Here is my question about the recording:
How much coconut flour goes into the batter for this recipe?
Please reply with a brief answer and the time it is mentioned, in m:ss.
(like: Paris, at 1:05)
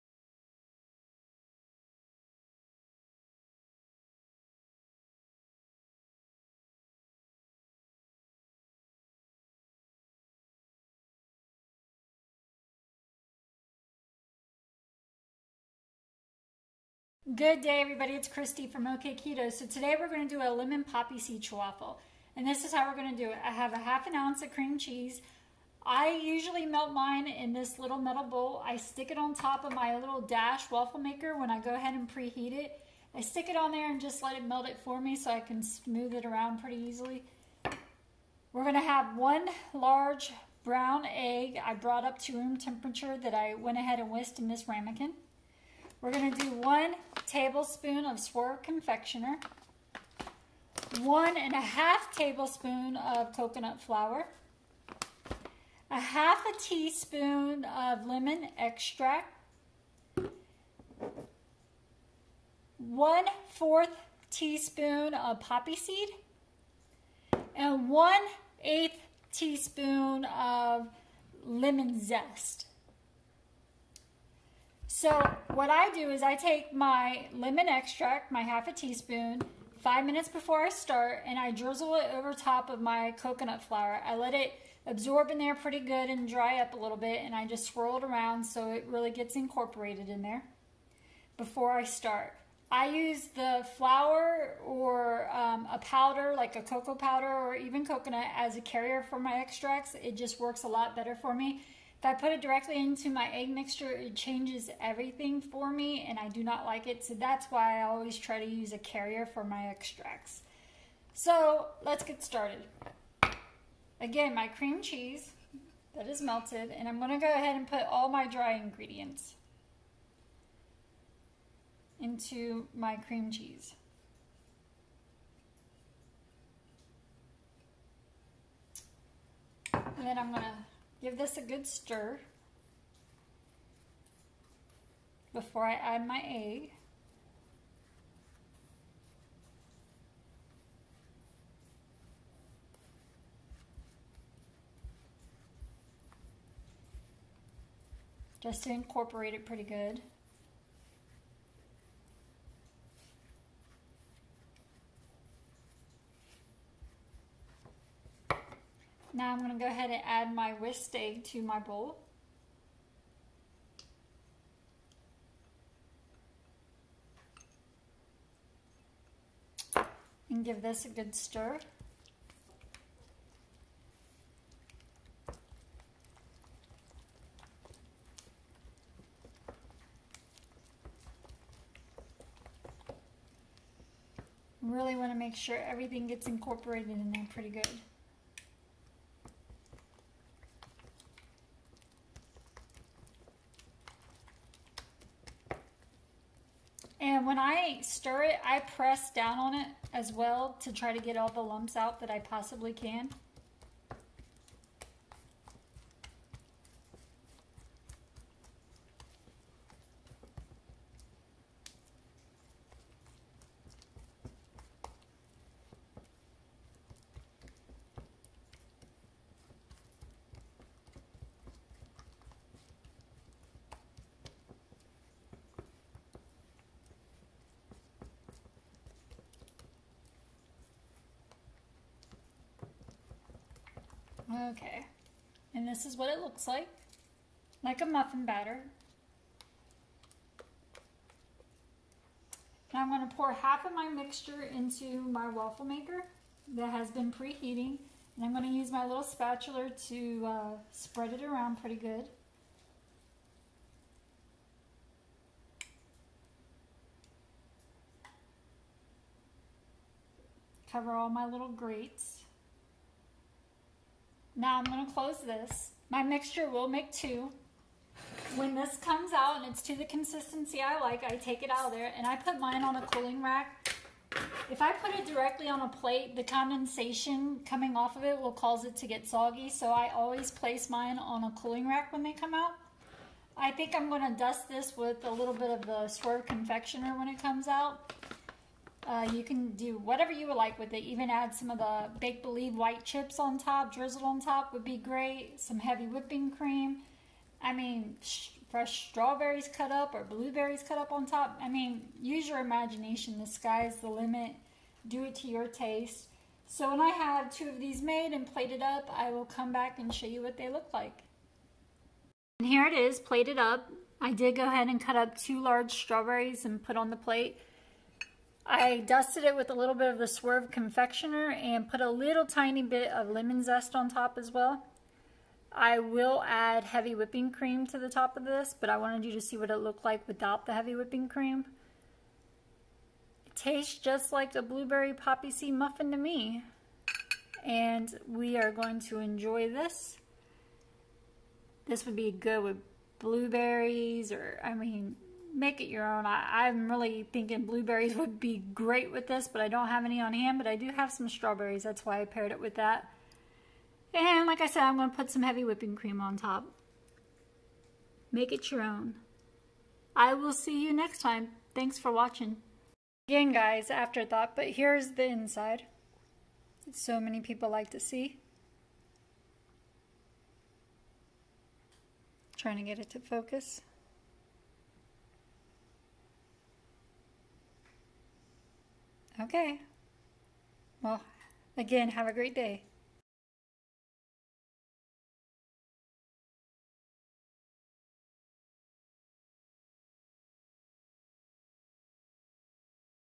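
1.5 tablespoons, at 0:51.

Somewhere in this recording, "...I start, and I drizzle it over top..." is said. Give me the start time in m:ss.
1:20.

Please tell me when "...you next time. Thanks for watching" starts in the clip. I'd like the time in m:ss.
6:00.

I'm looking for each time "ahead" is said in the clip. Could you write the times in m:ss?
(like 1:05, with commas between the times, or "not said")
0:31, 0:43, 1:57, 2:39, 5:14.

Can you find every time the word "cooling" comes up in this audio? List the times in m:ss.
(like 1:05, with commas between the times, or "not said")
4:32, 4:41.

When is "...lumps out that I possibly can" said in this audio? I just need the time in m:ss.
3:21.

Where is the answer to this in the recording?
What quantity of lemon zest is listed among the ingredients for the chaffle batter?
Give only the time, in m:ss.
1:07.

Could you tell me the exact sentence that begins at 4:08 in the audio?
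And I'm going to use my little spatula to uh, spread it around pretty good.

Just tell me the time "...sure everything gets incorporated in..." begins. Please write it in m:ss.
3:05.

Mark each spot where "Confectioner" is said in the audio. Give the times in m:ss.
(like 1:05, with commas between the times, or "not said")
0:48, 4:46, 5:20.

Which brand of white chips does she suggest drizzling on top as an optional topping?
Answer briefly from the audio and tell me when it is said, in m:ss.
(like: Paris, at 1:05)
Bake Believe, at 4:51.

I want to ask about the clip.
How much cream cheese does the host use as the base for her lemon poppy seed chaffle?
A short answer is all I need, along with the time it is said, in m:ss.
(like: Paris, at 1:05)
half an ounce, at 0:23.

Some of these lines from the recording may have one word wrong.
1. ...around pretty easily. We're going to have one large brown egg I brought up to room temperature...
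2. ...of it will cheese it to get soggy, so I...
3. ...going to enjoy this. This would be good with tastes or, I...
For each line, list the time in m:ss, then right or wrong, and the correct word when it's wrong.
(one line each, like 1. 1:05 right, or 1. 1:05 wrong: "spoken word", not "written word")
1. 0:36 right
2. 4:37 wrong: "cause", not "cheese"
3. 5:38 wrong: "blueberries", not "tastes".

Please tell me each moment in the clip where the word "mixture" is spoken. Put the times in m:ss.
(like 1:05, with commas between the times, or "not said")
1:43, 4:03, 4:26.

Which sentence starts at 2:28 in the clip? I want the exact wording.
Just to incorporate it pretty good.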